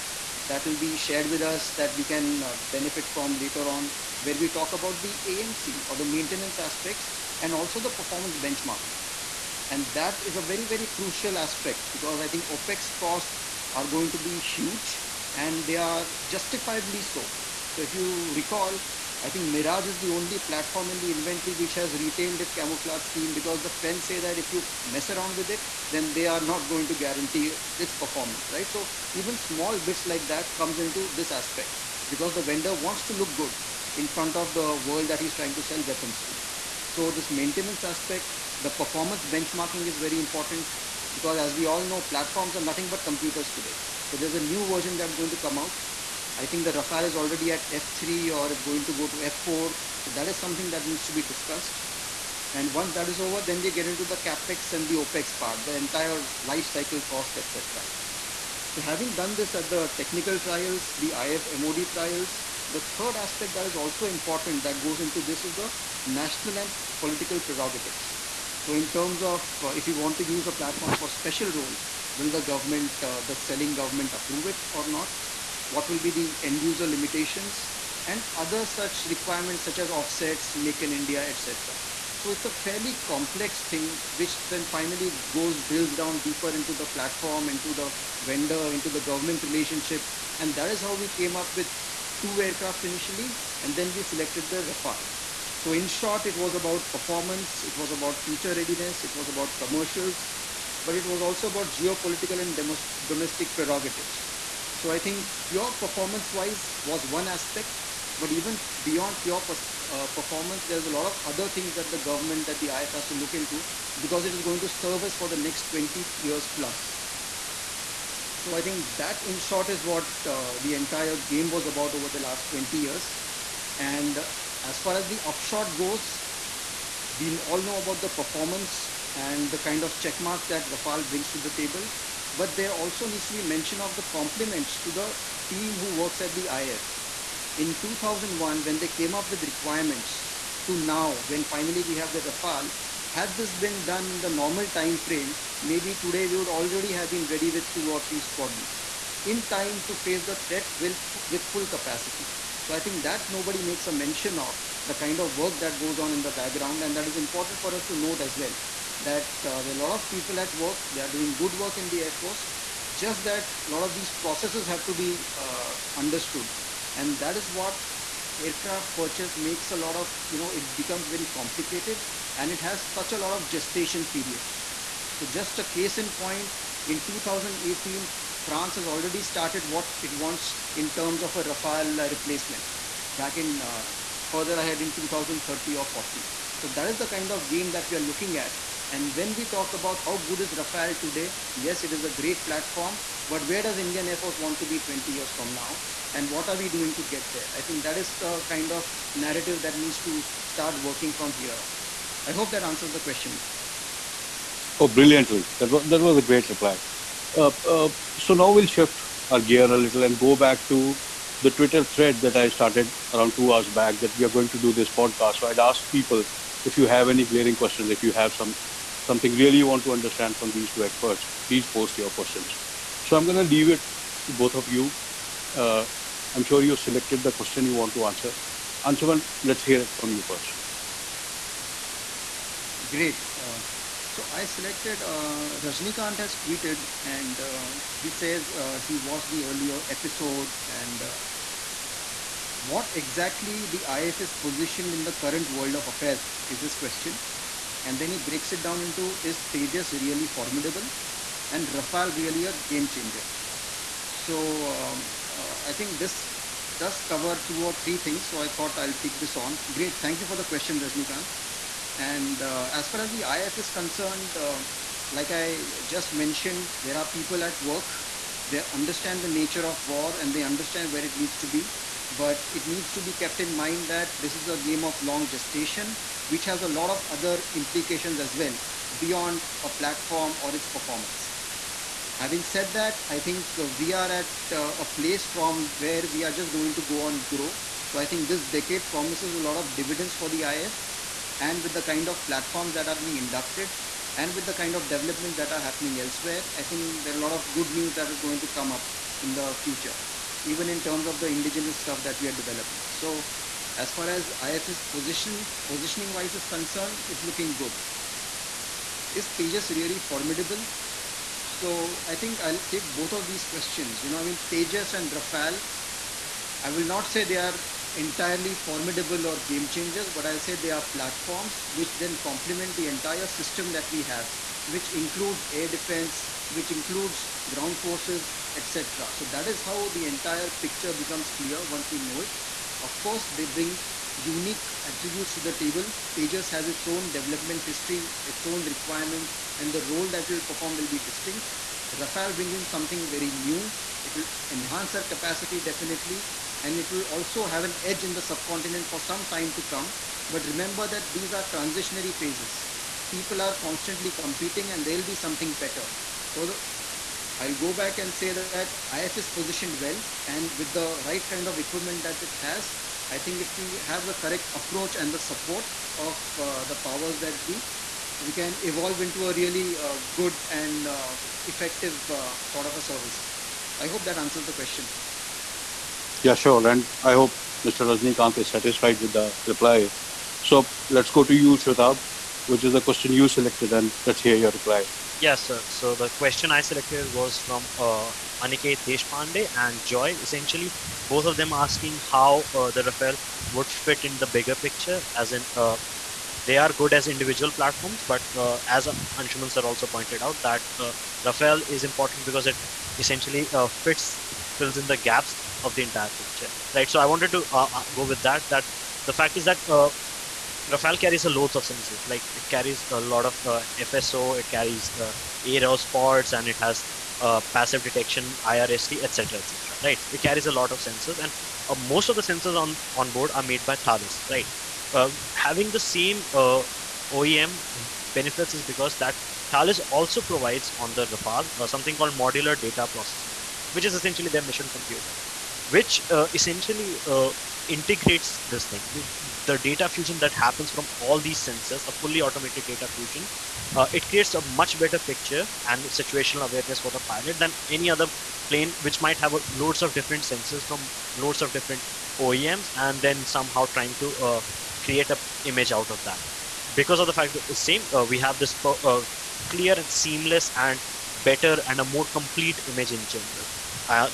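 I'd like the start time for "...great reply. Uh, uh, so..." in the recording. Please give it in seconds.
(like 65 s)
206 s.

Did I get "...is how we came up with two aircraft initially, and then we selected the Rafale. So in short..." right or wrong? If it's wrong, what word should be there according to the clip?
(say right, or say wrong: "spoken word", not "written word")
right.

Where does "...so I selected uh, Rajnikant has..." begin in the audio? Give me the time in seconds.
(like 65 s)
234 s.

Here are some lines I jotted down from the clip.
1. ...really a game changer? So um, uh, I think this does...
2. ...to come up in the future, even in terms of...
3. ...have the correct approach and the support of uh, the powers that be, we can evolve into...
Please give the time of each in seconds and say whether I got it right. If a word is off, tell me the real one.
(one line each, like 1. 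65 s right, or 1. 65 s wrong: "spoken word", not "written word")
1. 252 s right
2. 298 s right
3. 363 s right.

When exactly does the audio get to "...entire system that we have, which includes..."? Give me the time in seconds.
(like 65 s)
322 s.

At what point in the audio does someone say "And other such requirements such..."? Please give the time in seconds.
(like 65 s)
78 s.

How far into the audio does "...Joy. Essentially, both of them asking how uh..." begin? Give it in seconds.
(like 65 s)
389 s.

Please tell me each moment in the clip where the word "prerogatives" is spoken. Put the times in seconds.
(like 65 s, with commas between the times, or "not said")
67 s, 103 s.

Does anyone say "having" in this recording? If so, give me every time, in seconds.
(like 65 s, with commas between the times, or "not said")
58 s, 282 s, 425 s.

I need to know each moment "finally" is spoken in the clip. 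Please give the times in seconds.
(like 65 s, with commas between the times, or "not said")
84 s, 141 s.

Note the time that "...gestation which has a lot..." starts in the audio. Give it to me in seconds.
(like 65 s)
275 s.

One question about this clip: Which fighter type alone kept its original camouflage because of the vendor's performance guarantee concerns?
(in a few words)
Mirage.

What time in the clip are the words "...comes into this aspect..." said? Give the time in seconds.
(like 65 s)
30 s.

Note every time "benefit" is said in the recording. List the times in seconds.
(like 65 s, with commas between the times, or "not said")
2 s, 428 s.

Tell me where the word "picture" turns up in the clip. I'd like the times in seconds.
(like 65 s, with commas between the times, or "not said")
330 s, 394 s, 406 s, 444 s.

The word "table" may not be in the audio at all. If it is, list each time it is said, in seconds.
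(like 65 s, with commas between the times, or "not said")
131 s, 335 s.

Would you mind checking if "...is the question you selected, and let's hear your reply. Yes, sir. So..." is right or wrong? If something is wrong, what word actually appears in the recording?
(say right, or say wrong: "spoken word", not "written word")
right.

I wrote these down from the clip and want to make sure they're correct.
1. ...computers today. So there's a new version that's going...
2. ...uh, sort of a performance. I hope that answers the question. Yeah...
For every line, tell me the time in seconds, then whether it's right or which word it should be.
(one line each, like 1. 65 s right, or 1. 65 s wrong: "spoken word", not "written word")
1. 43 s right
2. 372 s wrong: "service", not "performance".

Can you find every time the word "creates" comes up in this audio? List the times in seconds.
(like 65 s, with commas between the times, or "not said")
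444 s, 454 s.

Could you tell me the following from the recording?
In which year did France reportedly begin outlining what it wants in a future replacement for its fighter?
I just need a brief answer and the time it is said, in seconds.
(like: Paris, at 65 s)
2018, at 177 s.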